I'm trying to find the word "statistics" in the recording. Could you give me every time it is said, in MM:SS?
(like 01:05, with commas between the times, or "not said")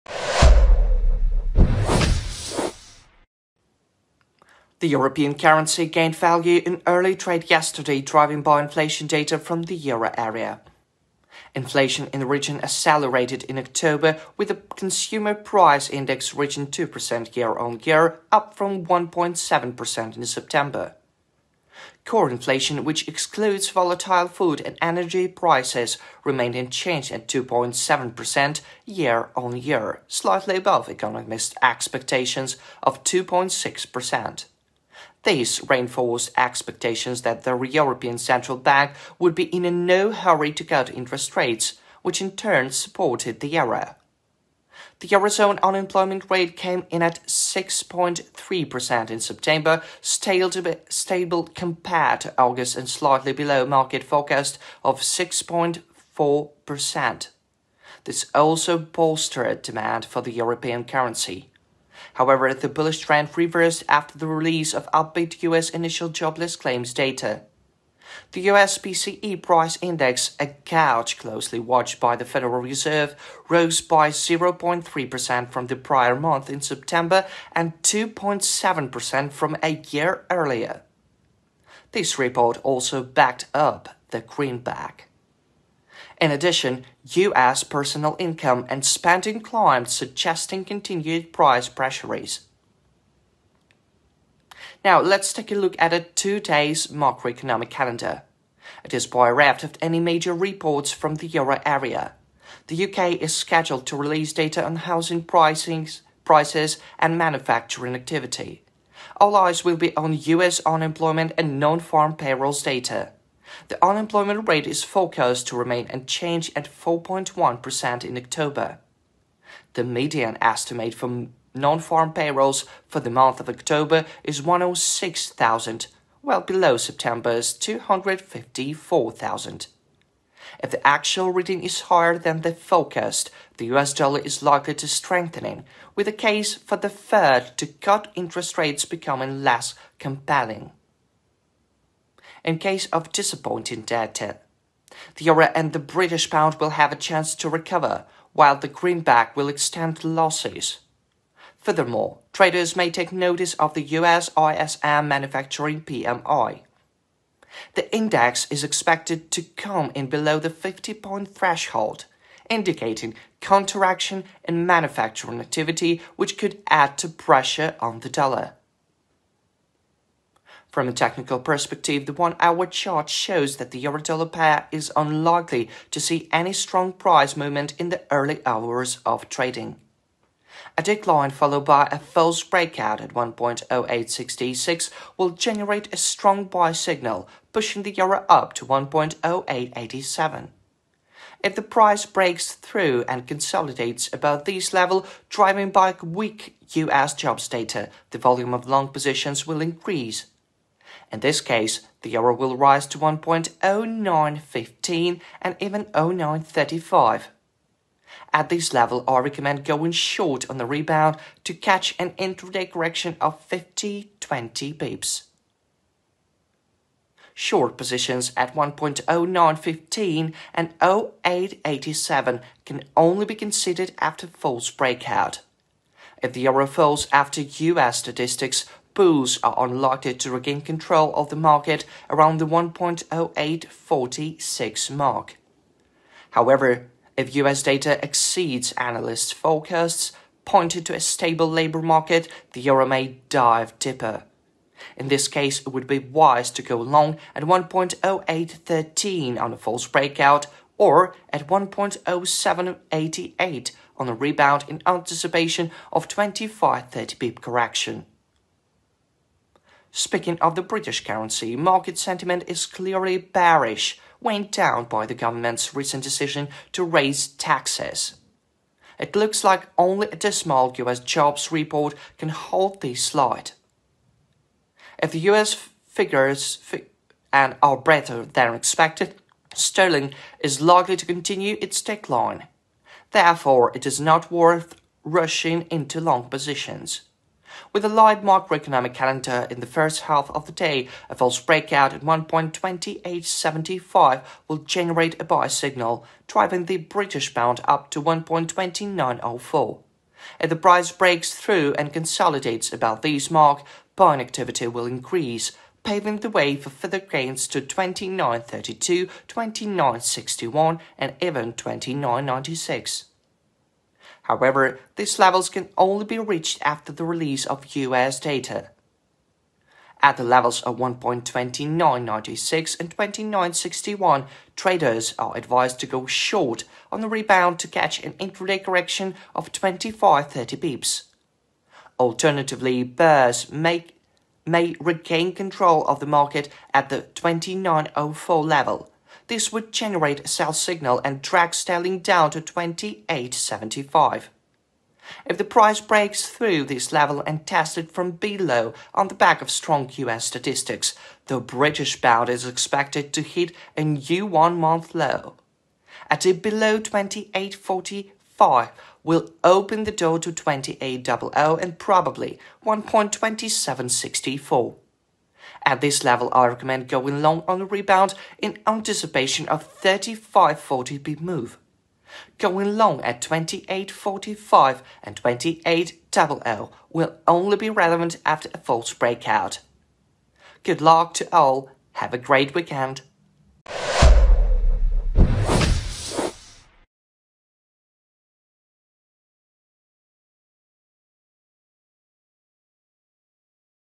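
03:47, 05:50.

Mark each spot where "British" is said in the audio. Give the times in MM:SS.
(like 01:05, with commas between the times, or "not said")
02:25, 04:20, 04:56, 05:51.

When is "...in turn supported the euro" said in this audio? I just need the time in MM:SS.
00:42.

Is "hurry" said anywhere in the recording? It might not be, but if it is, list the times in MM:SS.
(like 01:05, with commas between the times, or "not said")
00:40.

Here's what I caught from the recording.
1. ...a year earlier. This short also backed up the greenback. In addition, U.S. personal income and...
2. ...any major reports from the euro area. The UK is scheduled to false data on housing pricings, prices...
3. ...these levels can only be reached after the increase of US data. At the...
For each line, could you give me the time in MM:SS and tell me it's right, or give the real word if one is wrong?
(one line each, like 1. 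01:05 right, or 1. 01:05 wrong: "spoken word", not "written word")
1. 01:19 wrong: "report", not "short"
2. 01:39 wrong: "release", not "false"
3. 05:14 wrong: "release", not "increase".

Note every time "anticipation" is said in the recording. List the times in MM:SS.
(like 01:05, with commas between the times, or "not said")
04:14, 06:08.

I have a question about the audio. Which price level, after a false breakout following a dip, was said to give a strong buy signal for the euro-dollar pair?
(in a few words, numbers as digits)
1.0866.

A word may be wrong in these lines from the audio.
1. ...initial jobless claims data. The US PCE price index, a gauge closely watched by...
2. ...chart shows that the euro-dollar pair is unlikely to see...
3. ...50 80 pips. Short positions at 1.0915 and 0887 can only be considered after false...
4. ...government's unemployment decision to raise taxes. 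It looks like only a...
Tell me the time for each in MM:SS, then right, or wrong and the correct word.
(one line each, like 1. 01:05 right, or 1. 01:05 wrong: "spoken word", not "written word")
1. 01:05 right
2. 02:52 right
3. 03:33 wrong: "20", not "80"
4. 04:25 wrong: "recent", not "unemployment".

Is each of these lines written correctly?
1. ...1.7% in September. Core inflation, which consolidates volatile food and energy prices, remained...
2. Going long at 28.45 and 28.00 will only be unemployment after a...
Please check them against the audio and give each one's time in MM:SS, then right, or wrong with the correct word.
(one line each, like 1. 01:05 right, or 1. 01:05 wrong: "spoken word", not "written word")
1. 00:18 wrong: "excludes", not "consolidates"
2. 06:12 wrong: "relevant", not "unemployment".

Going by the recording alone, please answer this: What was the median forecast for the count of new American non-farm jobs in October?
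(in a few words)
106,000.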